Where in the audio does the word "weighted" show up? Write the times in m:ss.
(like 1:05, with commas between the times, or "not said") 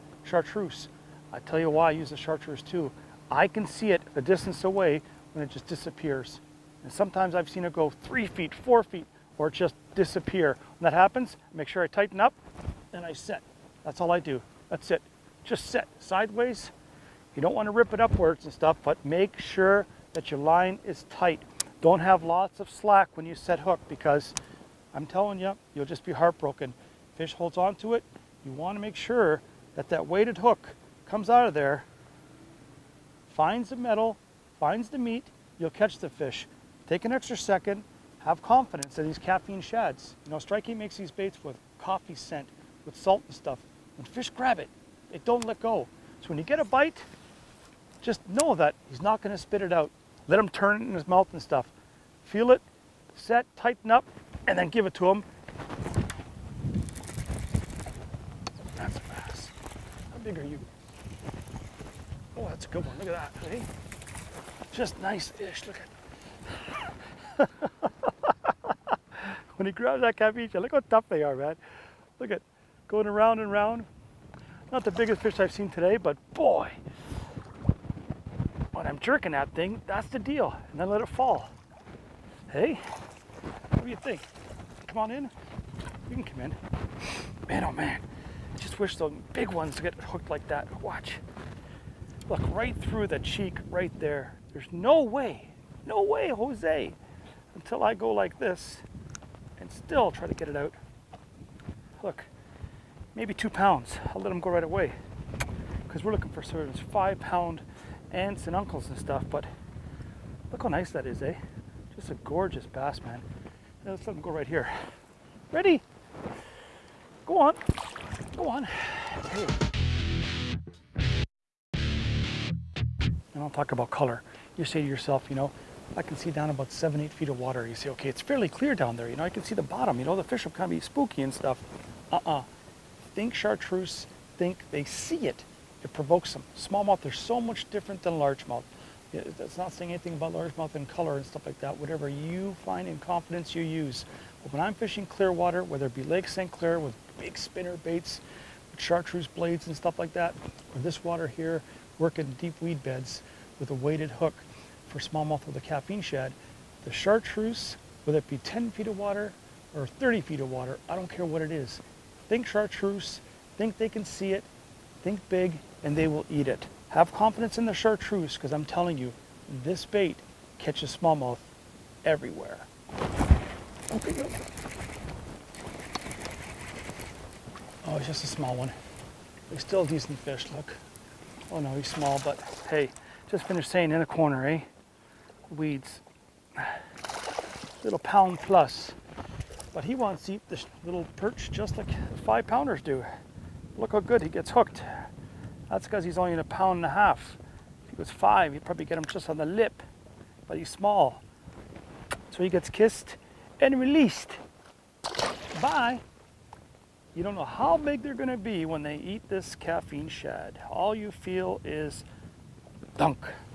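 0:30, 2:33.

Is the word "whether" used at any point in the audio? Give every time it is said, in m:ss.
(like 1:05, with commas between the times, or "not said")
2:25, 2:38.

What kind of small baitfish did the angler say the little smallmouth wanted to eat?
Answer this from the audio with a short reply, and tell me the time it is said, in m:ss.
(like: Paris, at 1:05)
perch, at 3:11.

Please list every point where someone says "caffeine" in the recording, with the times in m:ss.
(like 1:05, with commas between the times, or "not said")
0:39, 2:35, 3:29.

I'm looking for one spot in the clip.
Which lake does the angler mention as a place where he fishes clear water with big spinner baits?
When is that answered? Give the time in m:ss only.
2:26.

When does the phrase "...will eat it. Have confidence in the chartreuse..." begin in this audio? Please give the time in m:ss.
2:46.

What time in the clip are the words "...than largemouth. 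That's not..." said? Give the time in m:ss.
2:18.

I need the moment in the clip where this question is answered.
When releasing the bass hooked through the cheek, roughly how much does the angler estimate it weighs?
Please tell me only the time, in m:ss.
1:43.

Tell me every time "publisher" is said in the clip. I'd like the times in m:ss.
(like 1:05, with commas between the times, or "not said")
not said.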